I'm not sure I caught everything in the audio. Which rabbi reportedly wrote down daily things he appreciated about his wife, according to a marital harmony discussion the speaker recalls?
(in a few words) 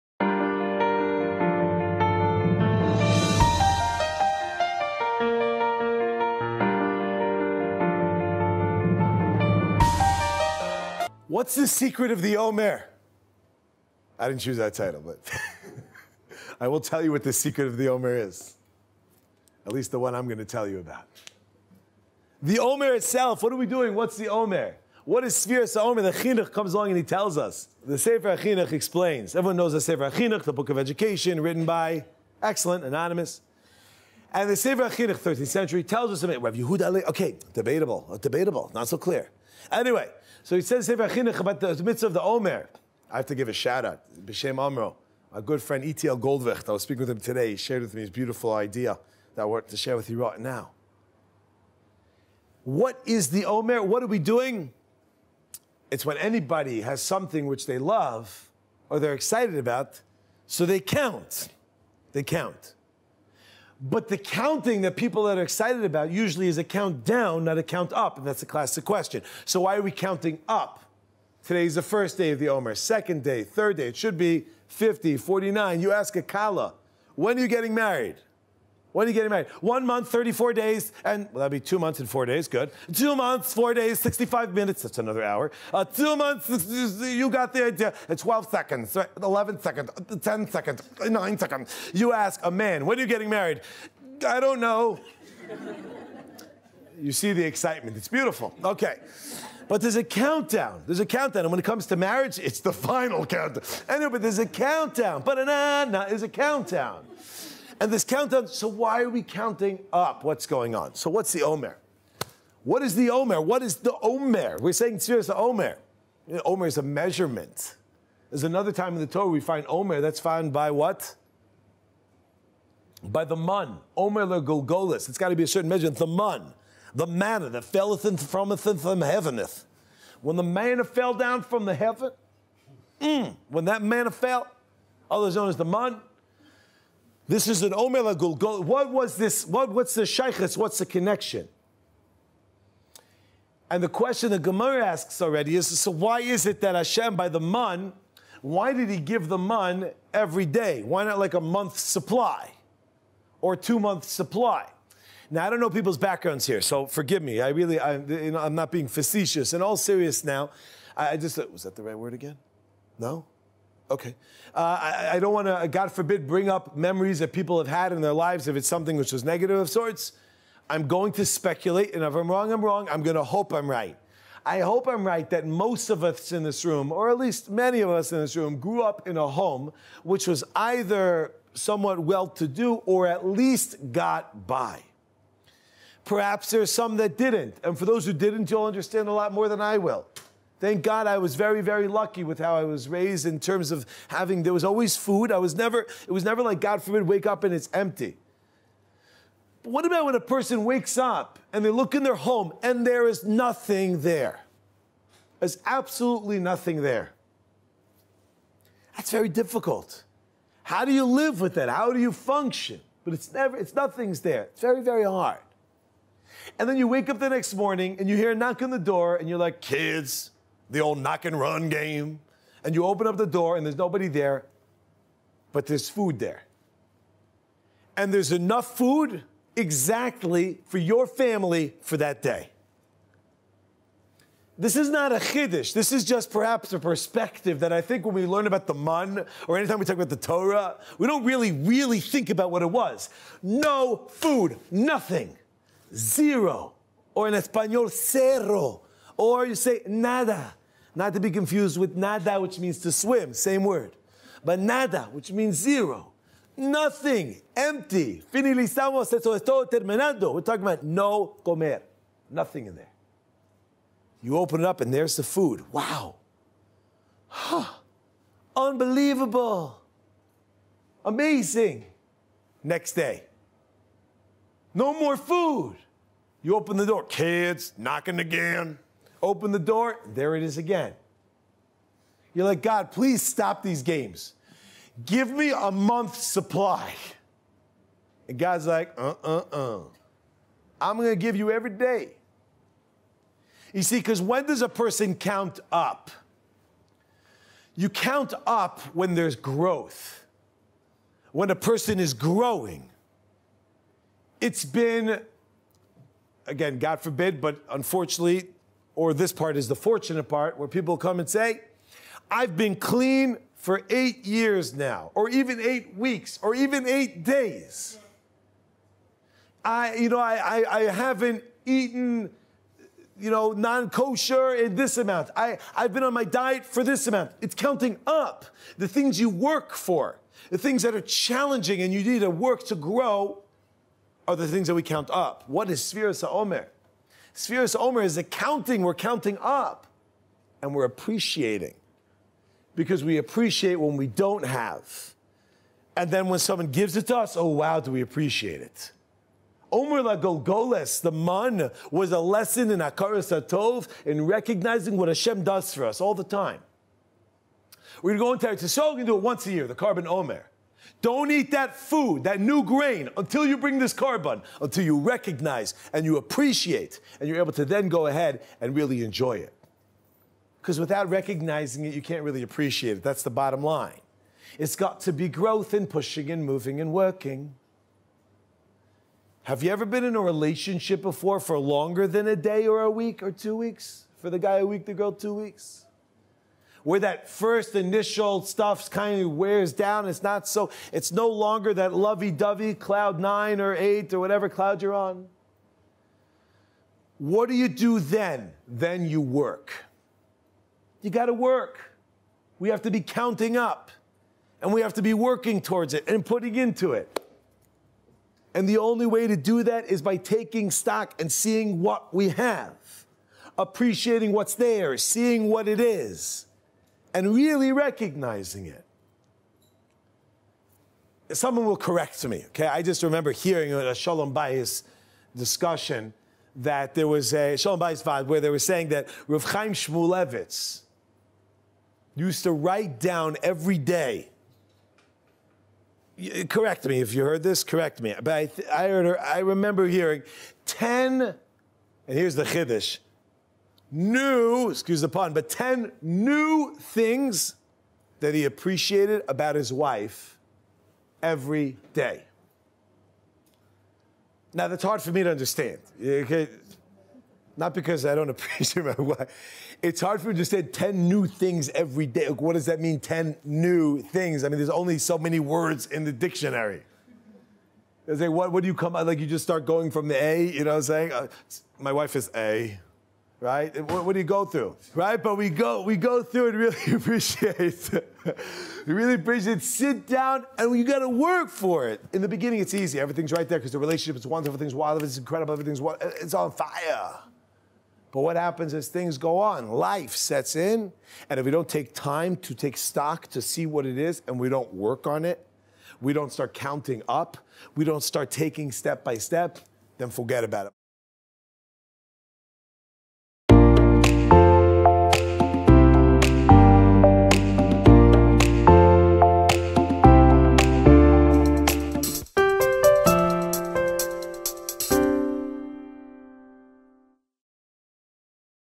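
Rav Chaim Shmulevitz.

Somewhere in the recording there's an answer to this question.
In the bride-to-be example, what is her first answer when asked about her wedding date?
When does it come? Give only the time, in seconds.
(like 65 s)
80 s.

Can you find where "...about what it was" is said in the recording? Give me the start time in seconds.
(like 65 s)
242 s.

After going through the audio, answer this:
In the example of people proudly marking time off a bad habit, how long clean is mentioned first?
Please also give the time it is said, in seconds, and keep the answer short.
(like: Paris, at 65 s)
8 years, at 313 s.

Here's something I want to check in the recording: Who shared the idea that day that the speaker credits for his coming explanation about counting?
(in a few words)
Goldwicht.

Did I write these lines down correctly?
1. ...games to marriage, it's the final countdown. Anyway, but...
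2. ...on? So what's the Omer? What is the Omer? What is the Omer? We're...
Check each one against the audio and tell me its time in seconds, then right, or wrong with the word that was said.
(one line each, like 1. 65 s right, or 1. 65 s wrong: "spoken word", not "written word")
1. 101 s wrong: "comes", not "games"
2. 110 s right.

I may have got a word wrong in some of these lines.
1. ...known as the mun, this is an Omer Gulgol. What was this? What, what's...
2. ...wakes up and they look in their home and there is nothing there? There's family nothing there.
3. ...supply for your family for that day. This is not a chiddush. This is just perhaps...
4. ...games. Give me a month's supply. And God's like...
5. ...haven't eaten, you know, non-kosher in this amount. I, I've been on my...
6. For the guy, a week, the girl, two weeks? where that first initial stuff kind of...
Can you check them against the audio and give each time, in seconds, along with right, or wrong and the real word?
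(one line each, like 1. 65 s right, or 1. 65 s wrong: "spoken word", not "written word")
1. 135 s right
2. 200 s wrong: "absolutely", not "family"
3. 229 s wrong: "exactly", not "supply"
4. 283 s right
5. 320 s right
6. 384 s right.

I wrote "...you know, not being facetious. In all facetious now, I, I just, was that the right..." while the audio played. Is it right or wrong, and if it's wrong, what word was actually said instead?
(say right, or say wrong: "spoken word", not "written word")
wrong: "serious", not "facetious".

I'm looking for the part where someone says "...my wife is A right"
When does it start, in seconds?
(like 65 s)
471 s.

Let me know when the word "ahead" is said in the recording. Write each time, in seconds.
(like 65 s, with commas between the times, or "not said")
368 s.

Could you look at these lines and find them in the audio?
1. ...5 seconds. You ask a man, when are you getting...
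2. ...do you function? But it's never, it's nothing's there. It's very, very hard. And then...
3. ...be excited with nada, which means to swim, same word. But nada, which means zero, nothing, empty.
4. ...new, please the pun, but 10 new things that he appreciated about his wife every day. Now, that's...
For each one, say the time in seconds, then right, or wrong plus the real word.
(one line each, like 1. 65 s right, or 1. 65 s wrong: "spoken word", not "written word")
1. 91 s wrong: "9", not "5"
2. 211 s right
3. 251 s wrong: "confused", not "excited"
4. 443 s wrong: "excuse", not "please".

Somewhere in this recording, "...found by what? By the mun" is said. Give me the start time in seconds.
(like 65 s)
120 s.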